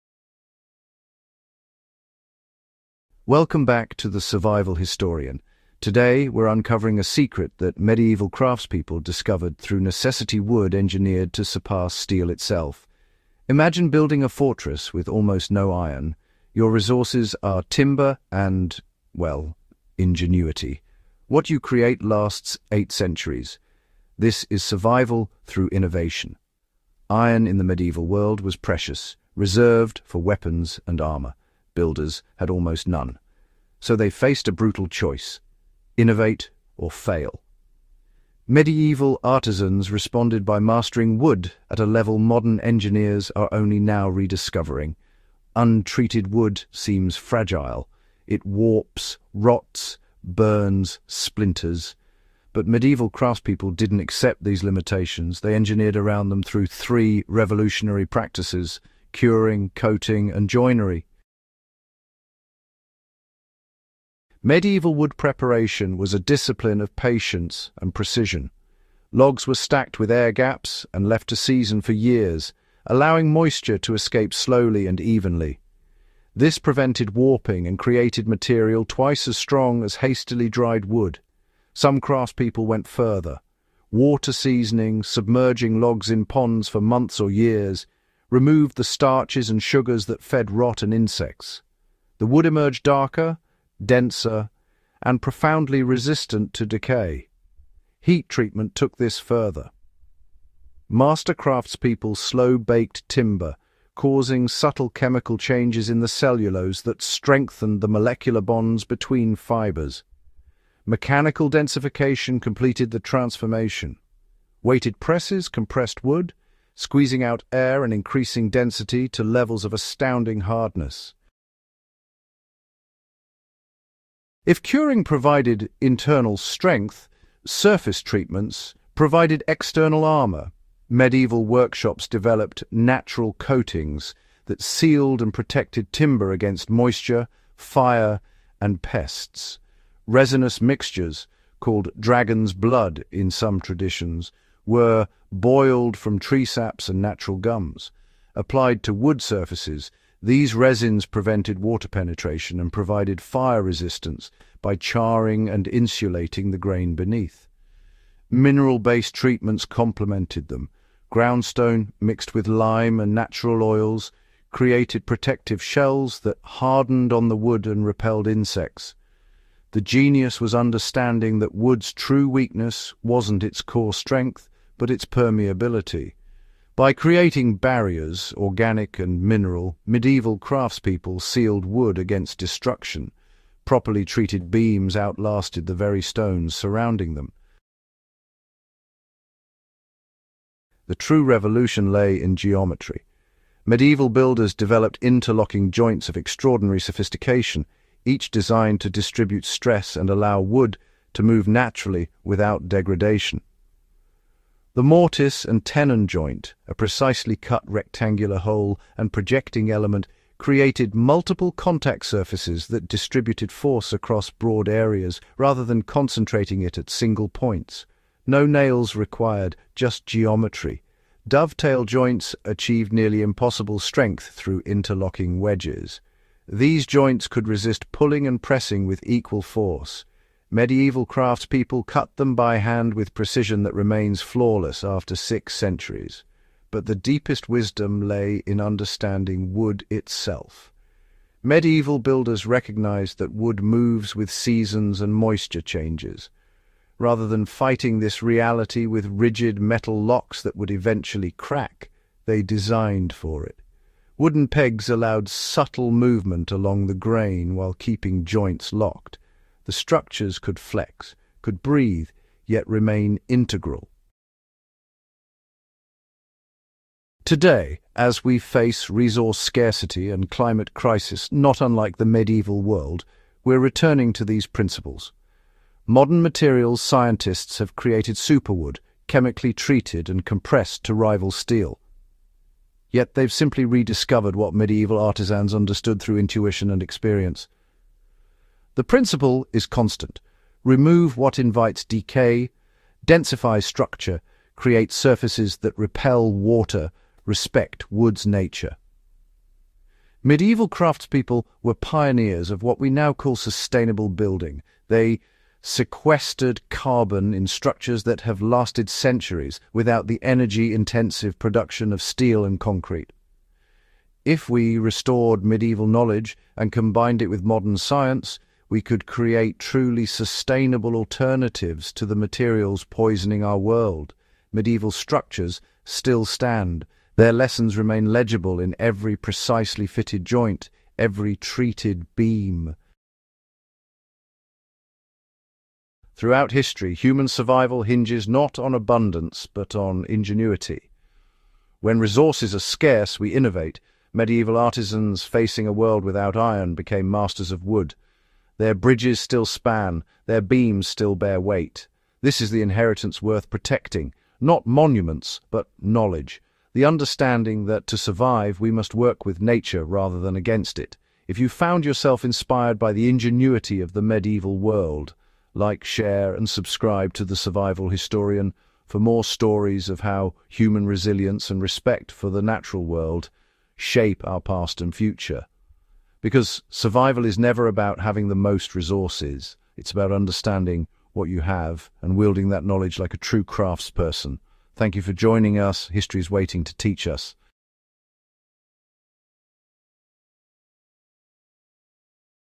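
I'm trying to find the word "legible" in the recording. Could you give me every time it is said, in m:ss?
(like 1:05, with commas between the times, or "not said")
5:28.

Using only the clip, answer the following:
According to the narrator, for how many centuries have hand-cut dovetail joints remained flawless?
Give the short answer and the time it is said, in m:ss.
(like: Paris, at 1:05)
6, at 3:55.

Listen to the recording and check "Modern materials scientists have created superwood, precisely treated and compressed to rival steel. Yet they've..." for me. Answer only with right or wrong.
wrong.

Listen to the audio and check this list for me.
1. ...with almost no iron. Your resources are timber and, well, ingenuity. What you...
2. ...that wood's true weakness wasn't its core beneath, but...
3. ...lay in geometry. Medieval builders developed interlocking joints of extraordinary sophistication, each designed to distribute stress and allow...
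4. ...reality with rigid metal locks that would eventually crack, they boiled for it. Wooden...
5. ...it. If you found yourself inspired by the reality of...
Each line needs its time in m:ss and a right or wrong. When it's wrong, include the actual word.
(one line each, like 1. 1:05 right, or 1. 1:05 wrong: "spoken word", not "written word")
1. 0:14 right
2. 2:51 wrong: "strength", not "beneath"
3. 3:11 right
4. 4:08 wrong: "designed", not "boiled"
5. 6:00 wrong: "ingenuity", not "reality".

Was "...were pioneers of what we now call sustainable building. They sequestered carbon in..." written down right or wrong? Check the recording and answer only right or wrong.
right.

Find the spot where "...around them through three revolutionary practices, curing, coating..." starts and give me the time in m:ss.
0:55.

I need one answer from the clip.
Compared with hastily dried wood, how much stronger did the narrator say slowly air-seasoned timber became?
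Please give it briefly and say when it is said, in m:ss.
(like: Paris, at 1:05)
twice as strong, at 1:18.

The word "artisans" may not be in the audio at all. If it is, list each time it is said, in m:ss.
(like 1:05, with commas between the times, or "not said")
0:39, 4:44, 5:44.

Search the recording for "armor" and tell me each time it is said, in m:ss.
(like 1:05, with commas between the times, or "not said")
0:30, 2:10.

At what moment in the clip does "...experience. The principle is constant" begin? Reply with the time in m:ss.
4:46.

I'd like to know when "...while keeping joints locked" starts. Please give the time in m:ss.
4:17.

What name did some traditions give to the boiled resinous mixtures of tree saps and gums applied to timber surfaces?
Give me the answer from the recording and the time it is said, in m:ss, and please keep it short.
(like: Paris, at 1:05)
dragon's blood, at 2:21.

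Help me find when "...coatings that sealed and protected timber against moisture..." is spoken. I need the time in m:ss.
2:13.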